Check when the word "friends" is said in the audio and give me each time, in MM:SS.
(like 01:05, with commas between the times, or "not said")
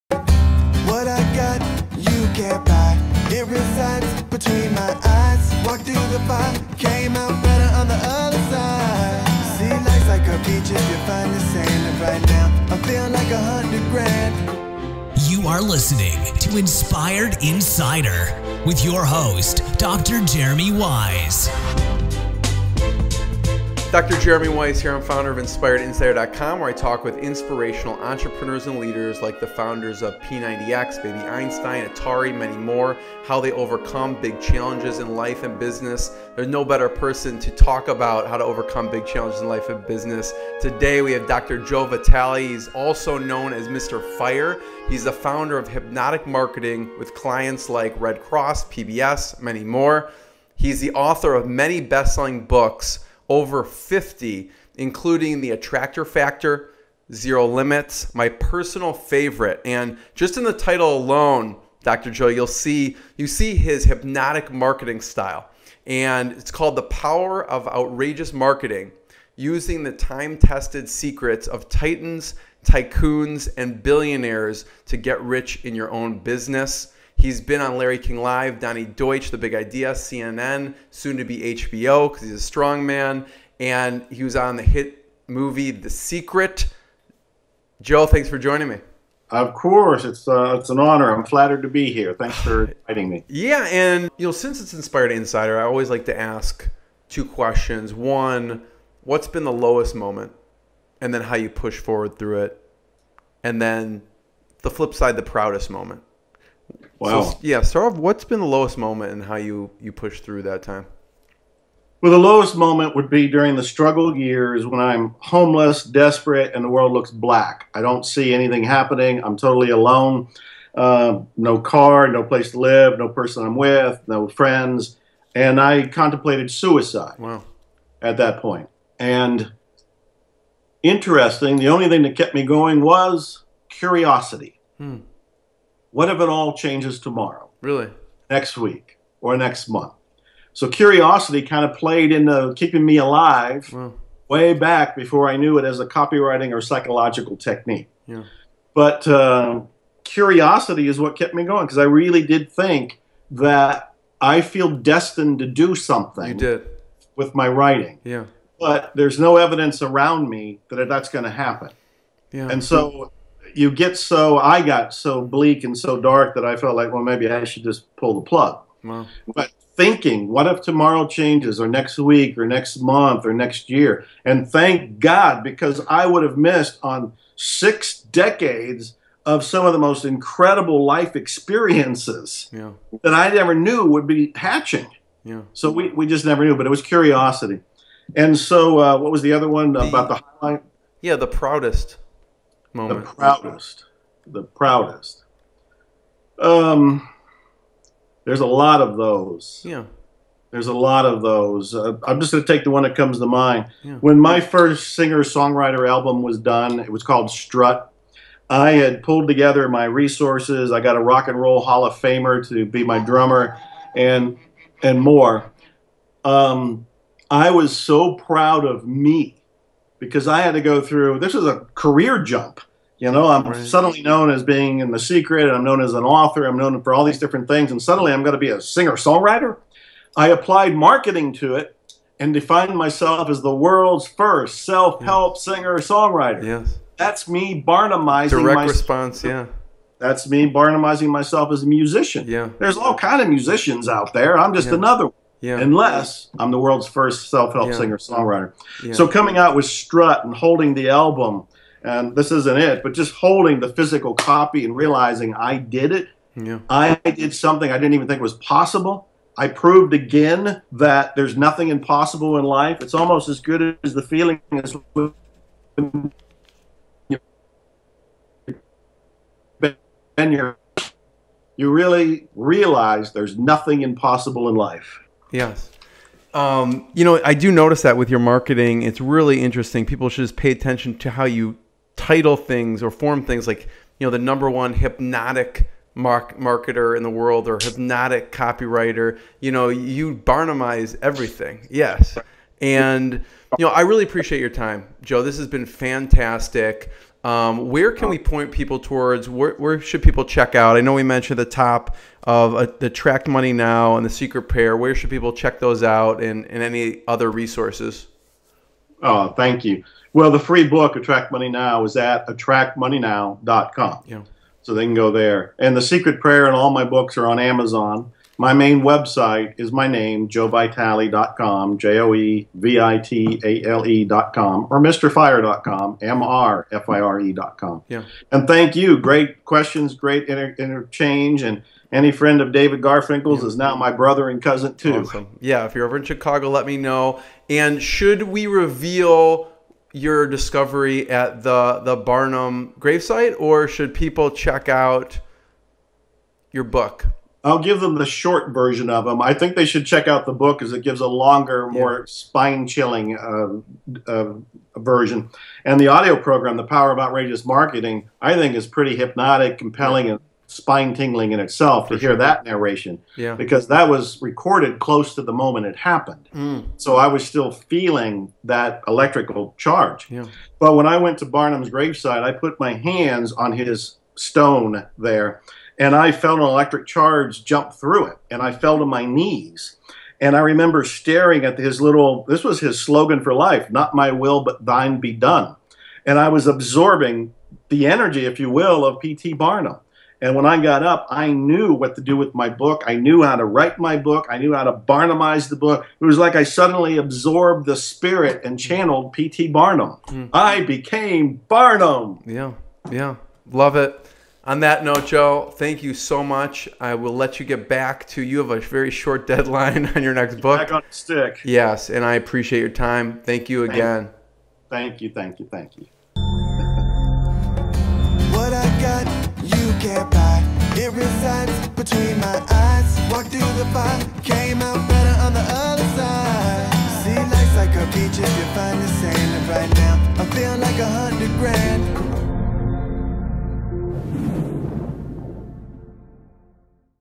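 02:04, 05:32.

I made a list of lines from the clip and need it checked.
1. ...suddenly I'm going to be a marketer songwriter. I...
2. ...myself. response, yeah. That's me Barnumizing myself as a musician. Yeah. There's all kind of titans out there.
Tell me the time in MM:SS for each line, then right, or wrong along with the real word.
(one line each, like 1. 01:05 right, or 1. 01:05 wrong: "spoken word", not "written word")
1. 03:47 wrong: "singer", not "marketer"
2. 03:58 wrong: "musicians", not "titans".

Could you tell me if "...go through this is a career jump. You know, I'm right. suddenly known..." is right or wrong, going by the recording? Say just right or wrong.
right.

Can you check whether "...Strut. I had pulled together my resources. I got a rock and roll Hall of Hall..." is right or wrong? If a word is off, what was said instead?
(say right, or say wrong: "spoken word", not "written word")
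wrong: "Famer", not "Hall".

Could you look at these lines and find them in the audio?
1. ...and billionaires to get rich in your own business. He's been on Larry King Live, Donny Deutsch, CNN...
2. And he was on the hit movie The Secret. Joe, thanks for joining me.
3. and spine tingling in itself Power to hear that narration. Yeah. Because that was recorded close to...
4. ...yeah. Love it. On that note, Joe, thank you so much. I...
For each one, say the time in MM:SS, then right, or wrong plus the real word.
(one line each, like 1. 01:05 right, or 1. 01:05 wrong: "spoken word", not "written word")
1. 01:13 wrong: "The", not "CNN"
2. 01:23 right
3. 06:00 wrong: "For", not "Power"
4. 06:42 right.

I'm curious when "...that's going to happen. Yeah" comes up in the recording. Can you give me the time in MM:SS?
02:40.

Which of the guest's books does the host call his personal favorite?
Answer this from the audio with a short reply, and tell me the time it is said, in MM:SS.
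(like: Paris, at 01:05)
Zero Limits, at 00:57.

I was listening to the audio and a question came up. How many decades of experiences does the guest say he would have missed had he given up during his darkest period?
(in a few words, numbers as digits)
6.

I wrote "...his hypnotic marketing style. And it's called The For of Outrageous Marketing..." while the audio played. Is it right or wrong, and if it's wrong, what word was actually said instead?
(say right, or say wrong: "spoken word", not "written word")
wrong: "Power", not "For".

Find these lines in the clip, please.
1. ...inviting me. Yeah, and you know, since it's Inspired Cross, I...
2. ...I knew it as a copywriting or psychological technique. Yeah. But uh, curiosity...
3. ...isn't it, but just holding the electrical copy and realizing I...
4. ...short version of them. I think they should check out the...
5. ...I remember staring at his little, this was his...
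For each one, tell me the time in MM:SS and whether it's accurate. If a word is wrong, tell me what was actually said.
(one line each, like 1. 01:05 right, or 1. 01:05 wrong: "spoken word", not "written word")
1. 01:32 wrong: "Insider", not "Cross"
2. 02:25 right
3. 04:12 wrong: "physical", not "electrical"
4. 05:48 right
5. 06:20 right.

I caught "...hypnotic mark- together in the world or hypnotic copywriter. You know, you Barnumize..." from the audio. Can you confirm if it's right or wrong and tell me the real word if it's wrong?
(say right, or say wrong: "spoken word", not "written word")
wrong: "marketer", not "together".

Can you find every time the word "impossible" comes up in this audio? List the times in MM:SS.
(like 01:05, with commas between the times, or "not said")
04:21, 04:33.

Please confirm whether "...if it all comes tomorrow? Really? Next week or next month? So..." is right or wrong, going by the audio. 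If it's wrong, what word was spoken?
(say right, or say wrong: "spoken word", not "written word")
wrong: "changes", not "comes".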